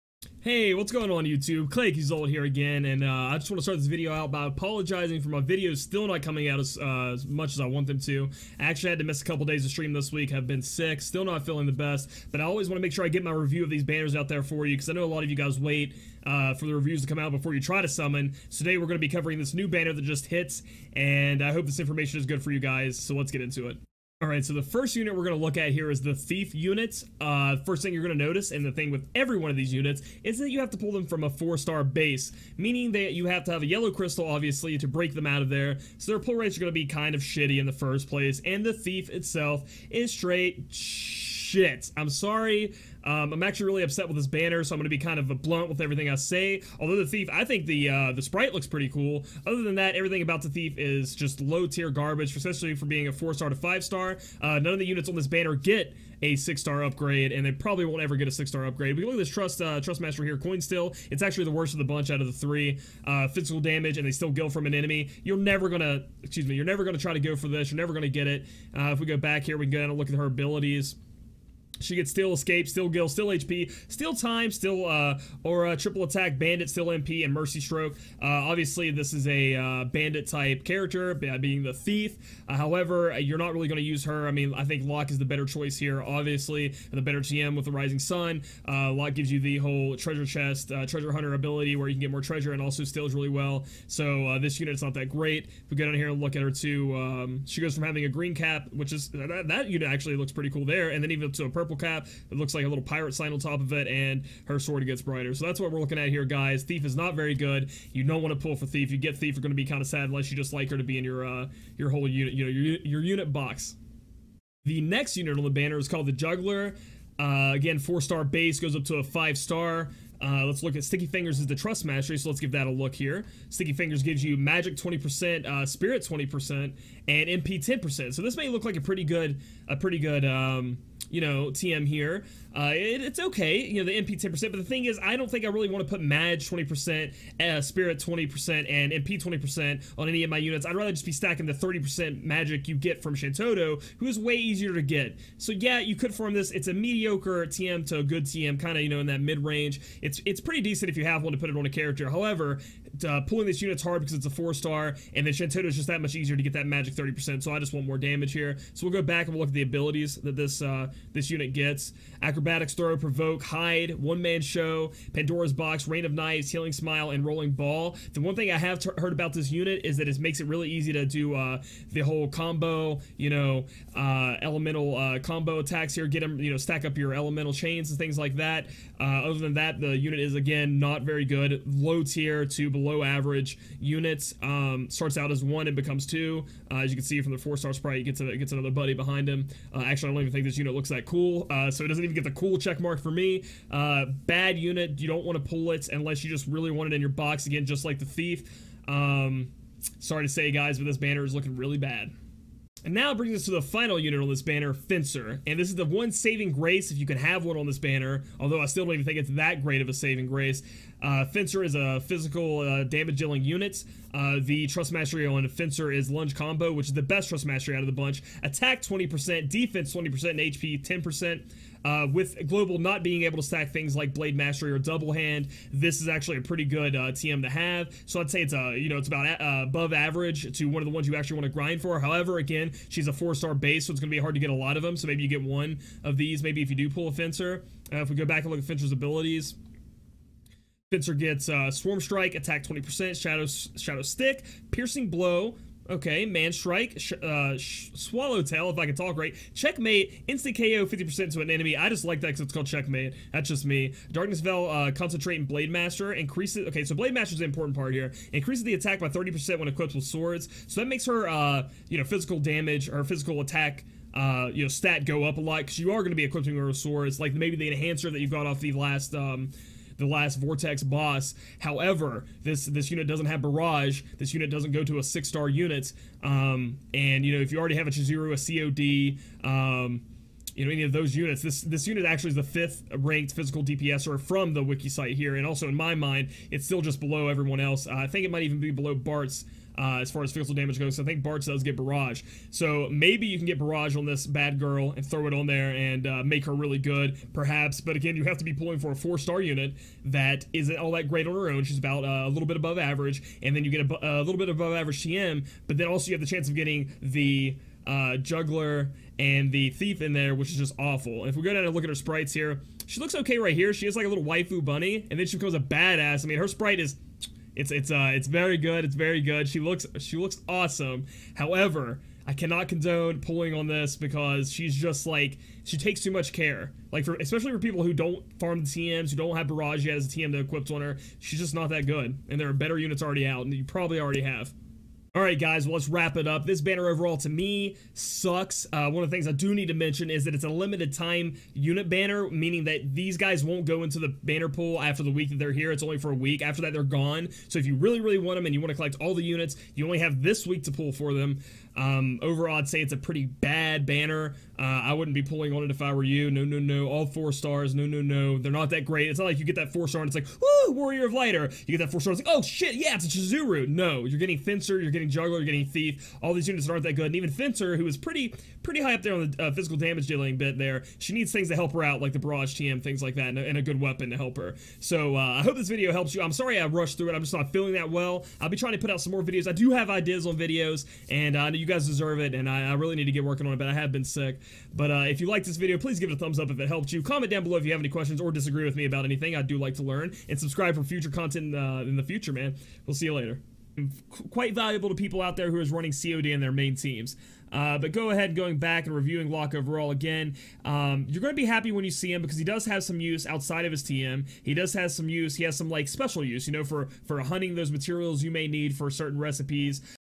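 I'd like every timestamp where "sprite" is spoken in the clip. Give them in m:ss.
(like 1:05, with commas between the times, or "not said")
0:48, 3:07, 5:11, 5:16.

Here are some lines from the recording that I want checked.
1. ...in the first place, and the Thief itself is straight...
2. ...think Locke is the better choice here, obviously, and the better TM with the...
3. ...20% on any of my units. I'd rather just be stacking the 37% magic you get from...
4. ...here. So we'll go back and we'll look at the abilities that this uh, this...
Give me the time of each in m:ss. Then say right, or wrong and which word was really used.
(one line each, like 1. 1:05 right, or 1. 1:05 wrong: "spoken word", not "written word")
1. 0:37 right
2. 1:24 right
3. 2:19 wrong: "30", not "37"
4. 2:38 right.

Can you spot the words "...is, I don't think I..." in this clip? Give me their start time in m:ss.
2:14.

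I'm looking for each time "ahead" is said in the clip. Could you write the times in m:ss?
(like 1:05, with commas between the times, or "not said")
6:38.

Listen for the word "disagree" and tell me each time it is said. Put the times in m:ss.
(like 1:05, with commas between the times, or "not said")
6:28.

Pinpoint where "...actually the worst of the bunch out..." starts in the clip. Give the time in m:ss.
1:01.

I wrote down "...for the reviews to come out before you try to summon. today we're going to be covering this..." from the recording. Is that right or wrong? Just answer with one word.
right.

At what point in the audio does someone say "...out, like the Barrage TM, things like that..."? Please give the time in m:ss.
6:11.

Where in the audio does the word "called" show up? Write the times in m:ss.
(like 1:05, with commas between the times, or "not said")
1:55, 4:12.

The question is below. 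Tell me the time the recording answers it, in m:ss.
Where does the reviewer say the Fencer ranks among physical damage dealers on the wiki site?
4:42.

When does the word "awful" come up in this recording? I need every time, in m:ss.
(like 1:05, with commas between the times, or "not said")
5:10.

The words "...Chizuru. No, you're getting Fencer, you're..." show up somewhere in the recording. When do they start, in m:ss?
6:03.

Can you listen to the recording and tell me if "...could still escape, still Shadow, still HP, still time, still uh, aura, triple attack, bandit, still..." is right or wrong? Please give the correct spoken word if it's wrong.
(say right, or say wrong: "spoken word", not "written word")
wrong: "Gil", not "Shadow".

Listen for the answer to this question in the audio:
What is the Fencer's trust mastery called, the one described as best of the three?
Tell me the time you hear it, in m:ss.
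3:36.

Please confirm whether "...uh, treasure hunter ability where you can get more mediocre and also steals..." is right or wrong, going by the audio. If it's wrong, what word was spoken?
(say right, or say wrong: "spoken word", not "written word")
wrong: "treasure", not "mediocre".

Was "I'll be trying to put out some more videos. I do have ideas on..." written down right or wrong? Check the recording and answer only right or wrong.
right.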